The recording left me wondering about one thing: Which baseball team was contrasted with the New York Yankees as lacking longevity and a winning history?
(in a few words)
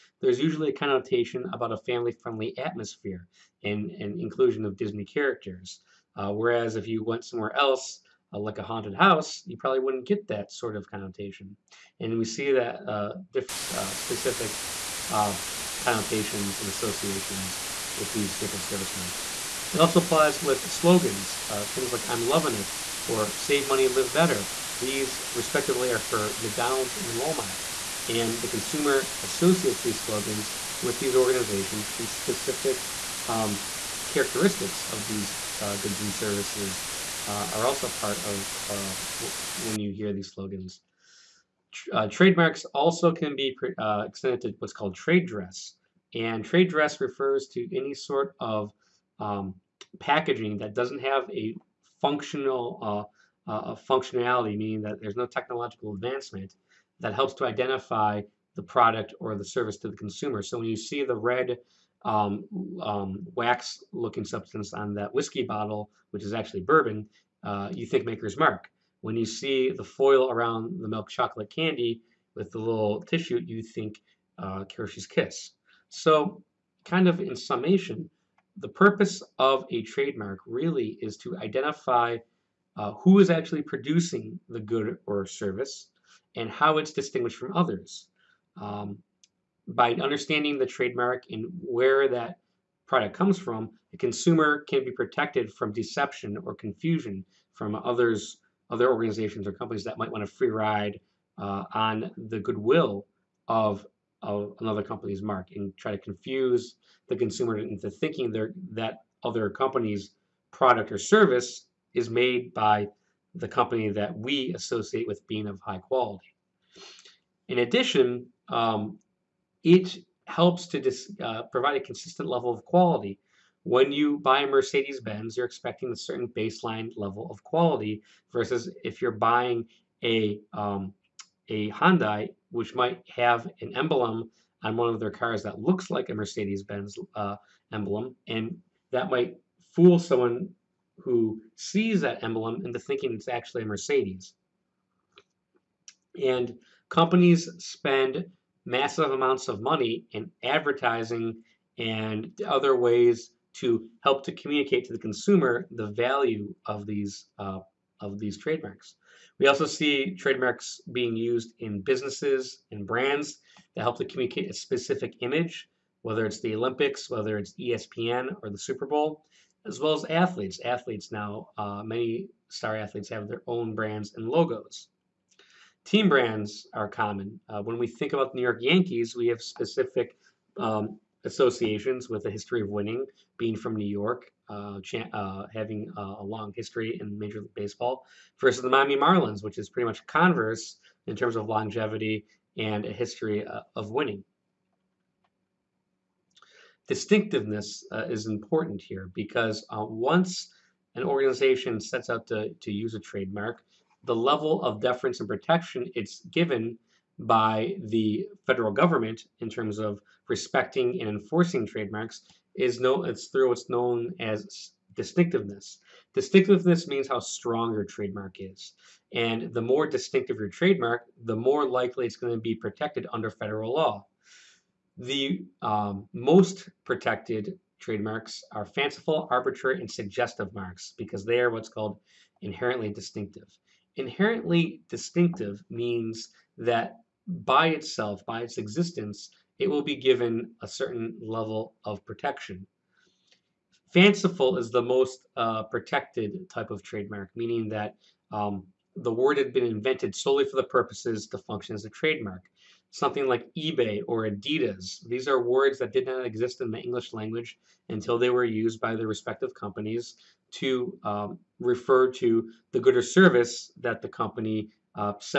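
Miami Marlins.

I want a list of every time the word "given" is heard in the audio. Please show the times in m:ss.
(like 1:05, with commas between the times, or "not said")
3:26, 3:59.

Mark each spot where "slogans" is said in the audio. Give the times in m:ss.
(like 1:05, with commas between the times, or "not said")
0:20, 0:30, 0:40.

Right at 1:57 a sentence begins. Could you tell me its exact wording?
In addition, um, it helps to uh, provide a consistent level of quality.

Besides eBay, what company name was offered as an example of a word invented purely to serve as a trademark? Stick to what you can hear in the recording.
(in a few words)
Adidas.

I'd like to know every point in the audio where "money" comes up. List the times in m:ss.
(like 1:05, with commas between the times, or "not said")
0:23, 2:29.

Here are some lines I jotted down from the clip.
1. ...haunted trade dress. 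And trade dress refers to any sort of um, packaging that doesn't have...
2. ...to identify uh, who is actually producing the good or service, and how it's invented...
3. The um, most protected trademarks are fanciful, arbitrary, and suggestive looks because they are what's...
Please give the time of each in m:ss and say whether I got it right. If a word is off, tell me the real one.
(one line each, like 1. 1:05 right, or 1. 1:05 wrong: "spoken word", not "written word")
1. 0:44 wrong: "called", not "haunted"
2. 1:21 wrong: "distinguished", not "invented"
3. 3:44 wrong: "marks", not "looks".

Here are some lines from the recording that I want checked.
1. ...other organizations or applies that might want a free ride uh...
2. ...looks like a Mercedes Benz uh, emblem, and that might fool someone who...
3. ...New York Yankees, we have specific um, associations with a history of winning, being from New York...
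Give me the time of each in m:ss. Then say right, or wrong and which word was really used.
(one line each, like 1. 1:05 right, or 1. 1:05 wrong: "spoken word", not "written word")
1. 1:38 wrong: "companies", not "applies"
2. 2:15 right
3. 2:58 right.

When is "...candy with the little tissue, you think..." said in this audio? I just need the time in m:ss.
1:11.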